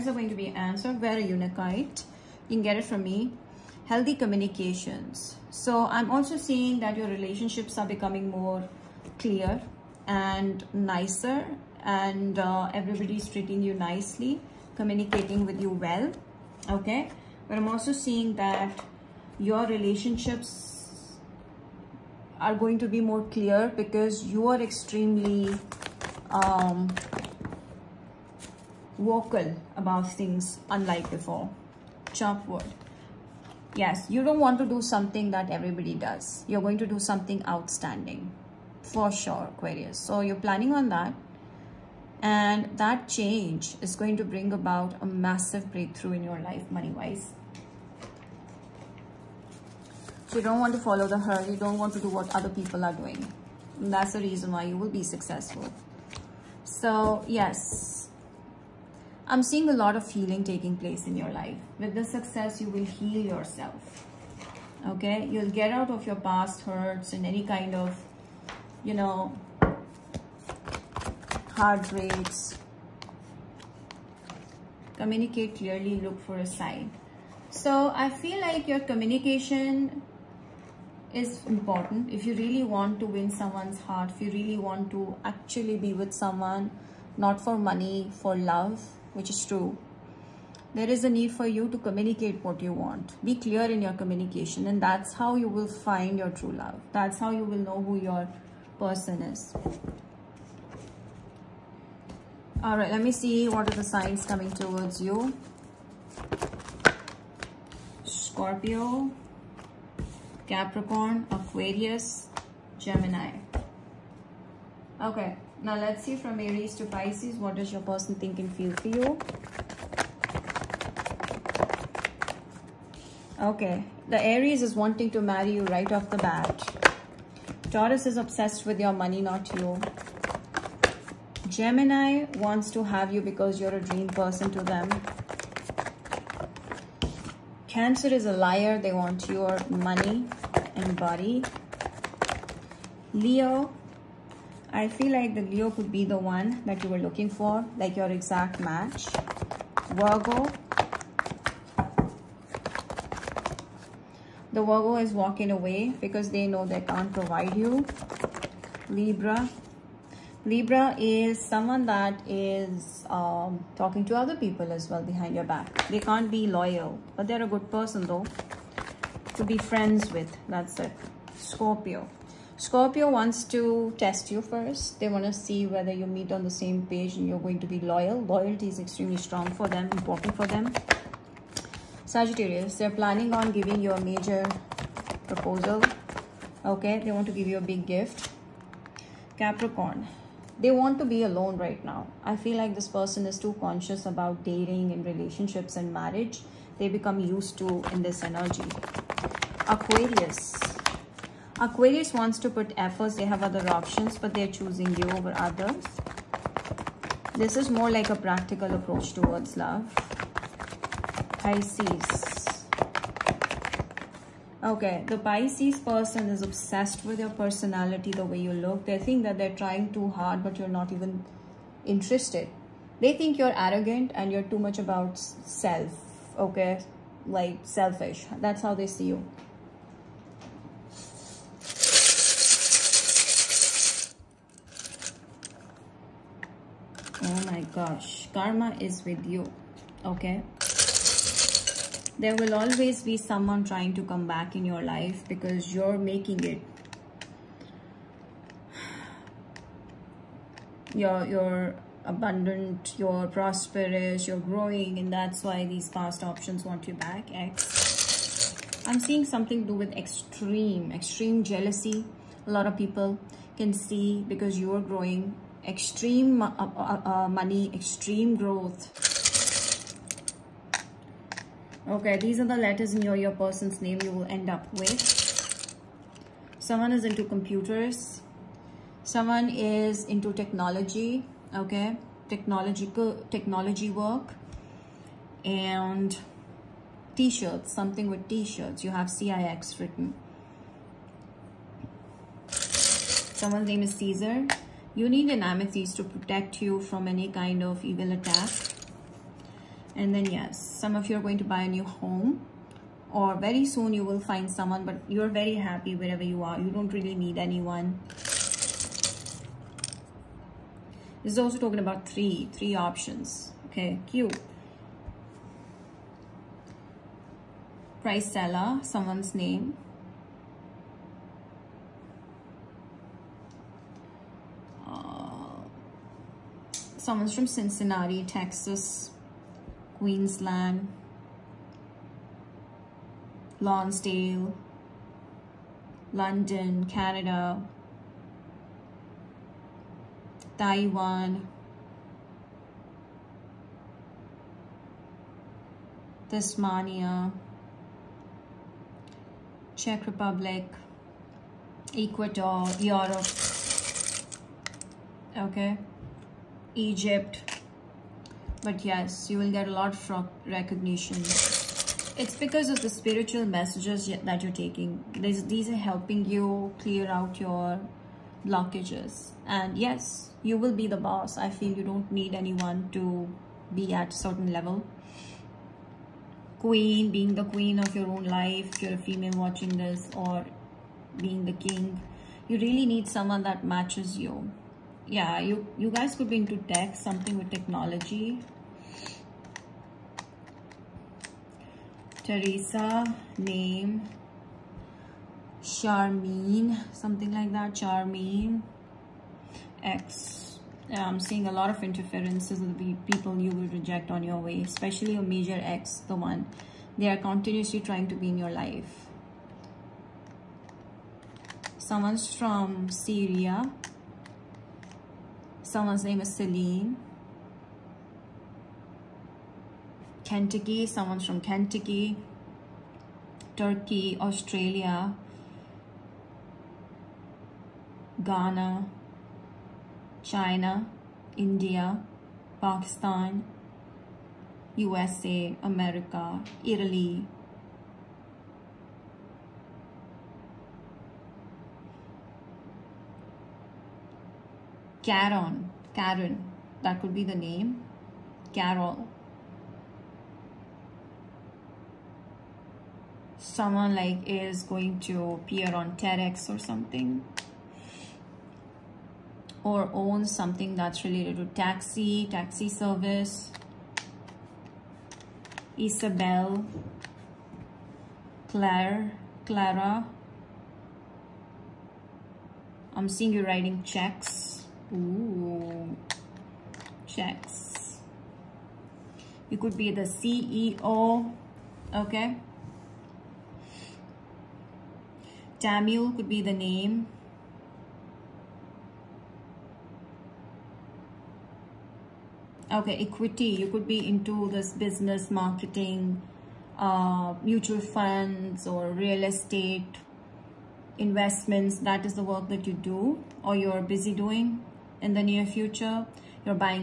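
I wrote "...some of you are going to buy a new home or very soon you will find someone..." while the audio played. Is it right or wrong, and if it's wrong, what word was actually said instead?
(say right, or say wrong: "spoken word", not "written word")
right.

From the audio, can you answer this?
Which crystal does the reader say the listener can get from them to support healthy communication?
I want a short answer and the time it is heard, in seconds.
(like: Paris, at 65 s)
Unakite, at 1 s.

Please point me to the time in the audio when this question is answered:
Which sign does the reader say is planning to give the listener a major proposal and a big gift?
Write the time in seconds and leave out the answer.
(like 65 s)
182 s.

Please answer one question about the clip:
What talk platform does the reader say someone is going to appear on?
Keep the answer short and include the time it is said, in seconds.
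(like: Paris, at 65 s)
TEDx, at 455 s.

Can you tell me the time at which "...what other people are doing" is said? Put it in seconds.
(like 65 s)
52 s.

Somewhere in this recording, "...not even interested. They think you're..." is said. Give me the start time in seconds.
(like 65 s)
220 s.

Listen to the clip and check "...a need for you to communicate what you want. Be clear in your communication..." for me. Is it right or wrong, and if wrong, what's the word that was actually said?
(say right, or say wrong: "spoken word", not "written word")
right.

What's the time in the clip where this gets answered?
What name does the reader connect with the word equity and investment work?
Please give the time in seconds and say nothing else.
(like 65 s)
485 s.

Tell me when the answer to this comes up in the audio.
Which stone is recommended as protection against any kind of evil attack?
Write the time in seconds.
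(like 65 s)
295 s.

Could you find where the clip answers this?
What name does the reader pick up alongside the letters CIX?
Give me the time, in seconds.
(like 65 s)
293 s.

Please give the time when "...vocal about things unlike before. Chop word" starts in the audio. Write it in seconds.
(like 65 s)
28 s.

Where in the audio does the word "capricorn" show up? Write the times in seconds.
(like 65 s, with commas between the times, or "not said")
110 s, 189 s.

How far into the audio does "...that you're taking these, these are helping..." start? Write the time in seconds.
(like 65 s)
364 s.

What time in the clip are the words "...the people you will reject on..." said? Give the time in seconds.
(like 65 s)
402 s.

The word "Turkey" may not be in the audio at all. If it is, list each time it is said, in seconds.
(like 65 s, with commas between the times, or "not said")
423 s.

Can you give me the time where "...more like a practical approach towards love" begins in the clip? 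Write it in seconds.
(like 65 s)
207 s.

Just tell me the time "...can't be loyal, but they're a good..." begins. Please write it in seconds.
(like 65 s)
165 s.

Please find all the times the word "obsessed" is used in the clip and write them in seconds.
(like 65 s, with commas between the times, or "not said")
128 s, 216 s.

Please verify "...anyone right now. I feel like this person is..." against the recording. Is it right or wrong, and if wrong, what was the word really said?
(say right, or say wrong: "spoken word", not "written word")
wrong: "alone", not "anyone".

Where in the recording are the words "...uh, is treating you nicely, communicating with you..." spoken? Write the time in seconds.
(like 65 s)
12 s.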